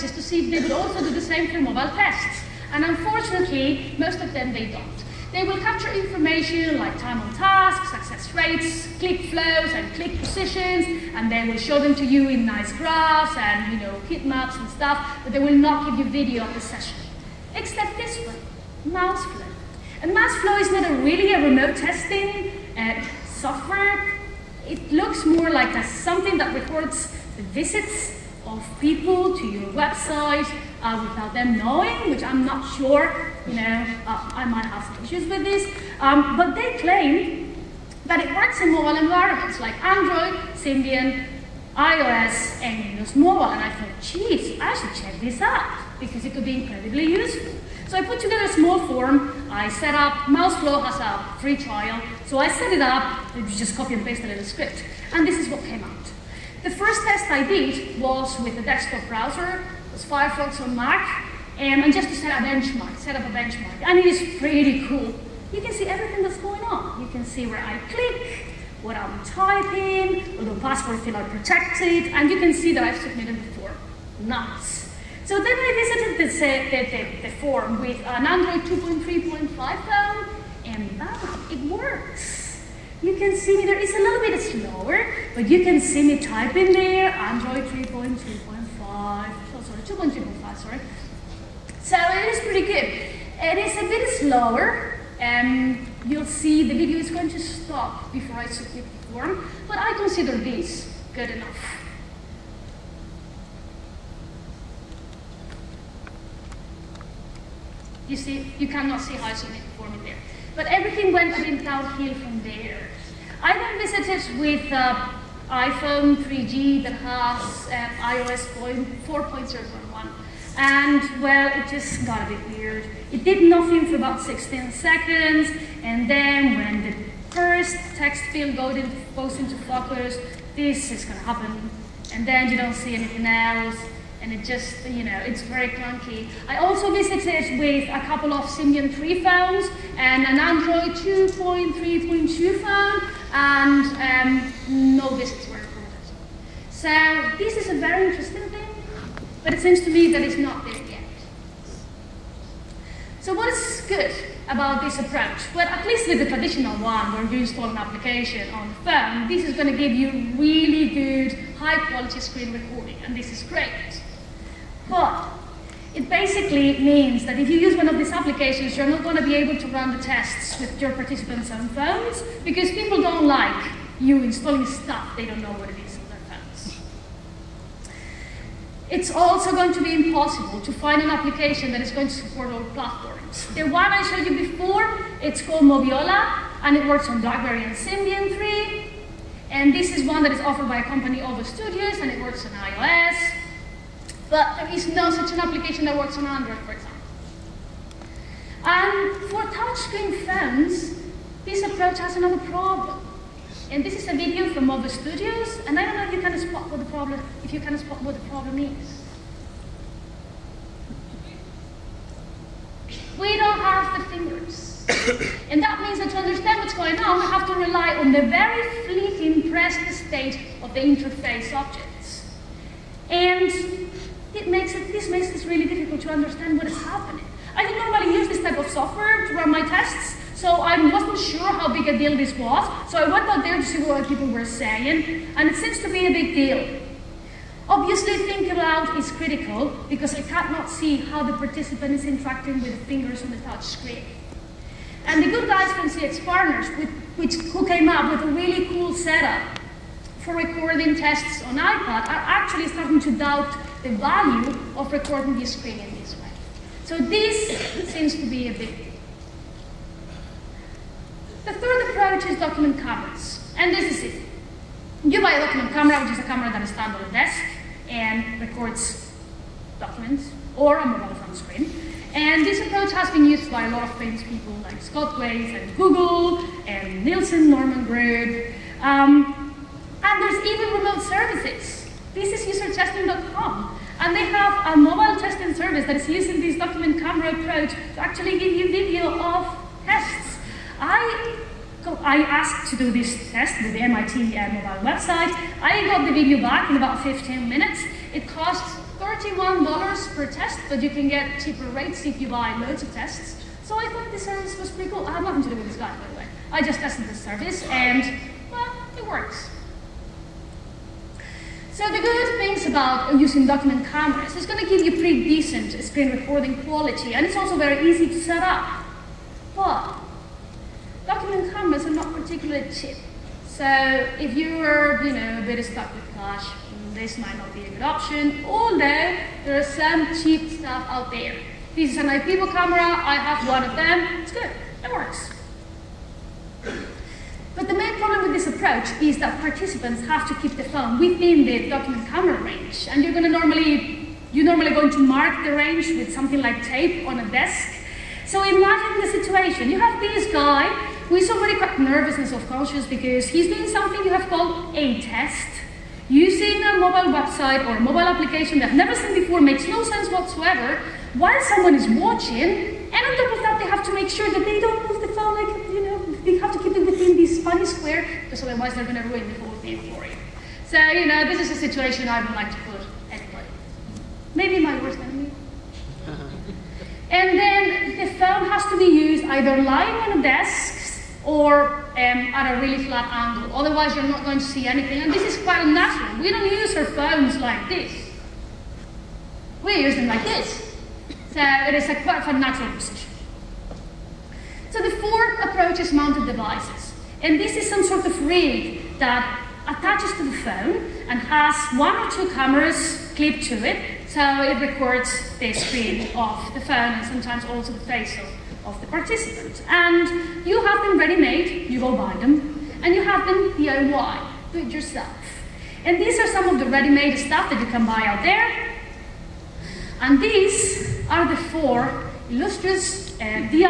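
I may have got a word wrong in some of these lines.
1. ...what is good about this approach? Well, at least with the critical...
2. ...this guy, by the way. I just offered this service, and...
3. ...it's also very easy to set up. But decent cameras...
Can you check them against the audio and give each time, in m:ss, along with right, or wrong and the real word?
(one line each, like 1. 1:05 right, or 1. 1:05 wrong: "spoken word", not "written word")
1. 2:33 wrong: "traditional", not "critical"
2. 5:05 wrong: "tested", not "offered"
3. 5:17 wrong: "document", not "decent".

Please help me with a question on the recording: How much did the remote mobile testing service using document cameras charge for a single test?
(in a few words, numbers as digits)
$31.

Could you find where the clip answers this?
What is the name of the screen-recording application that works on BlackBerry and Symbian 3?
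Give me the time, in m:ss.
3:05.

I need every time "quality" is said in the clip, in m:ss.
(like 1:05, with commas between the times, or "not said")
2:41, 5:16.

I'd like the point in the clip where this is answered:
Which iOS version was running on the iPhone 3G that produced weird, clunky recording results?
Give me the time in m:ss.
1:59.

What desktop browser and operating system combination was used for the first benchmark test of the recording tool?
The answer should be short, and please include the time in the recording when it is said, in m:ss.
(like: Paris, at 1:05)
Firefox on Mac, at 1:00.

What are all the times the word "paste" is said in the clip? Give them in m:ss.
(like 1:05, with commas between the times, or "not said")
0:54.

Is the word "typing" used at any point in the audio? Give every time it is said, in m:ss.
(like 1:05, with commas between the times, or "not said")
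1:09, 1:26.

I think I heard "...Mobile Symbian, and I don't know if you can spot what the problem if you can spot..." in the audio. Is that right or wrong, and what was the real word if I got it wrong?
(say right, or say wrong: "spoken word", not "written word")
wrong: "Studios", not "Symbian".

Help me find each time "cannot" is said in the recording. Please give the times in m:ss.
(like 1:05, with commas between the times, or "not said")
1:48, 4:00.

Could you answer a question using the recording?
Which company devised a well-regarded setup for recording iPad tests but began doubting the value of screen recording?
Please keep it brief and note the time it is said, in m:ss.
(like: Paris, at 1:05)
CX Partners, at 4:05.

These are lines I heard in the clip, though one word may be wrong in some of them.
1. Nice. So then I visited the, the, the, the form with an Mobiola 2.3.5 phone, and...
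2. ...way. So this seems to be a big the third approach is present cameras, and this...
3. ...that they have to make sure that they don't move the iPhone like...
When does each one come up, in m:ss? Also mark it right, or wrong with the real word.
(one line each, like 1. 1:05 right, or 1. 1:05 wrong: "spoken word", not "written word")
1. 1:14 wrong: "Android", not "Mobiola"
2. 4:16 wrong: "document", not "present"
3. 6:03 wrong: "phone", not "iPhone".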